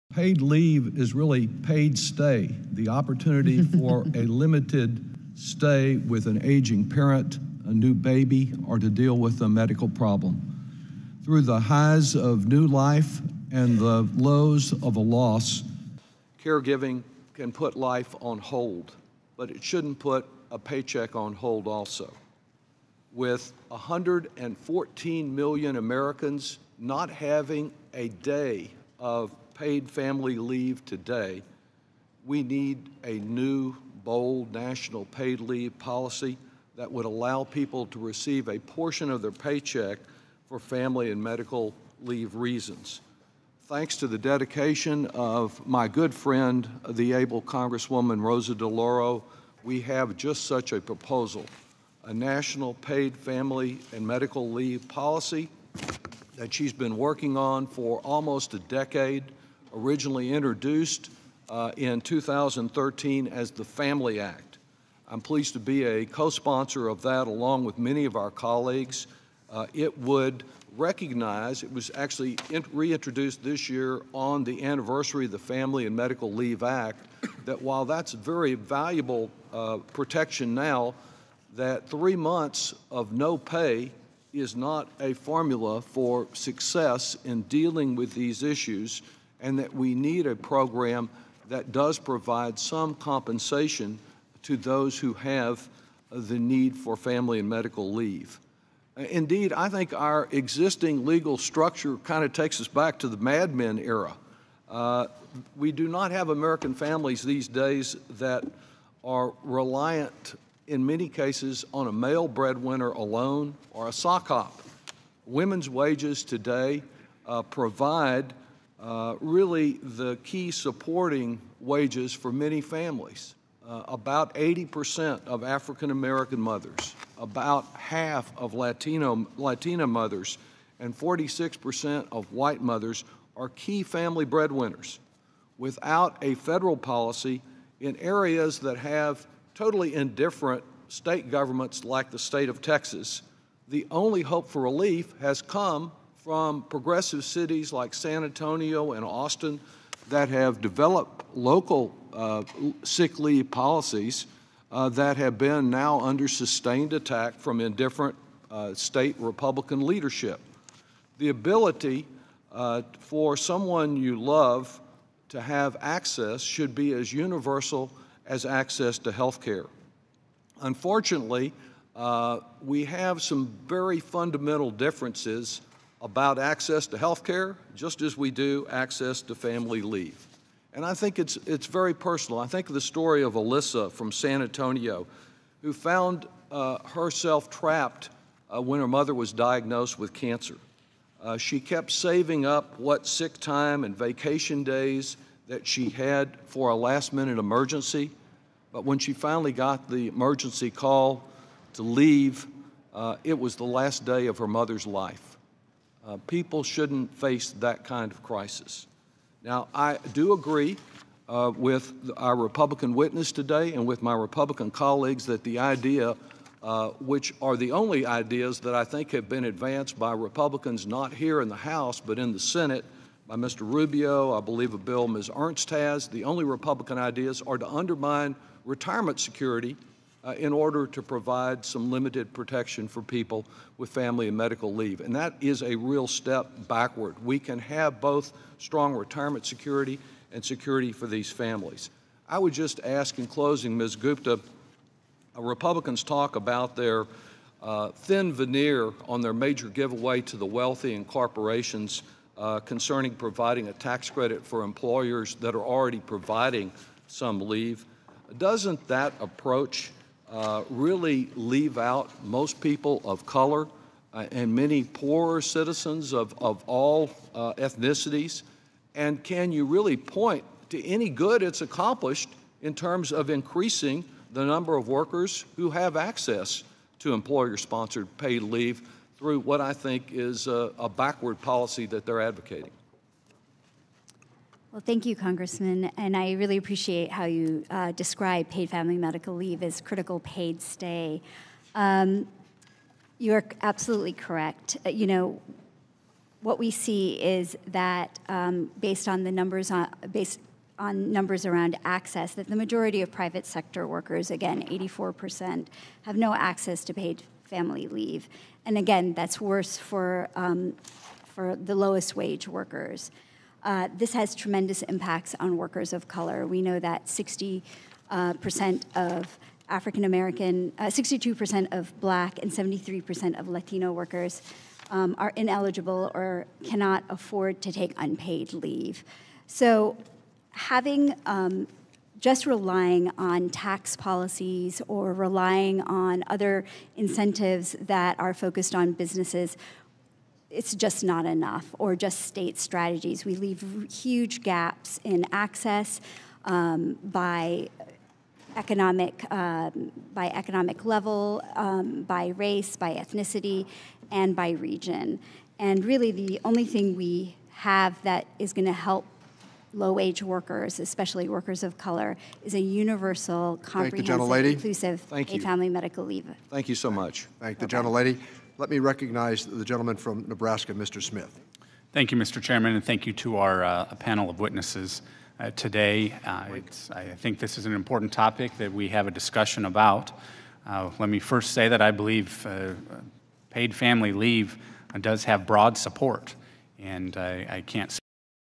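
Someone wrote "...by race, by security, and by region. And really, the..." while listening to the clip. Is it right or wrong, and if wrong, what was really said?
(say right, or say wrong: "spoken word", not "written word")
wrong: "ethnicity", not "security".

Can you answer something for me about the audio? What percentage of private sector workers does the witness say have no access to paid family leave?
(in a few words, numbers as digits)
84%.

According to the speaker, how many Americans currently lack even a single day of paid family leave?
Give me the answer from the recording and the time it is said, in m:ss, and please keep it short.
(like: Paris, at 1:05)
114 million, at 0:23.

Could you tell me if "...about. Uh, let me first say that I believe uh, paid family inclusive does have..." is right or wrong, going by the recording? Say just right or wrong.
wrong.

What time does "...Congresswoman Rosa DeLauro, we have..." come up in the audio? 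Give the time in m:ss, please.
0:47.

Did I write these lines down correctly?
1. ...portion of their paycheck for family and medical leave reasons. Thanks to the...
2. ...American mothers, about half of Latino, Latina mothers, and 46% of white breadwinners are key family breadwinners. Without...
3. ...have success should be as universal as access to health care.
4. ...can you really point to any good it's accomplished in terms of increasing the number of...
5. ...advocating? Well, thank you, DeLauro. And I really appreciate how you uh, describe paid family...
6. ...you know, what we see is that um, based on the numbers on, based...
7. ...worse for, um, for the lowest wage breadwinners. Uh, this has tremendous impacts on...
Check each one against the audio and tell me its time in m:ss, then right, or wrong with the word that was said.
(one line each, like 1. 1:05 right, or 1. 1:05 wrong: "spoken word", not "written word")
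1. 0:38 right
2. 2:05 wrong: "mothers", not "breadwinners"
3. 2:45 wrong: "access", not "success"
4. 4:29 right
5. 4:42 wrong: "Congressman", not "DeLauro"
6. 4:54 right
7. 5:09 wrong: "workers", not "breadwinners".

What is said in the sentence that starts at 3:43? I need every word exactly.
Rubio, I believe a bill Ms.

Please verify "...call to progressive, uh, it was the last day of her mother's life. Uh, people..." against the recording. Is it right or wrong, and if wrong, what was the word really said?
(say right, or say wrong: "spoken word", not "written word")
wrong: "leave", not "progressive".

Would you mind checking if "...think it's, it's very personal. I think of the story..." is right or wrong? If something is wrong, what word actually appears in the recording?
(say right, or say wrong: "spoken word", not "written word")
right.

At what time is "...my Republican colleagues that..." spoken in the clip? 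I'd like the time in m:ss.
3:34.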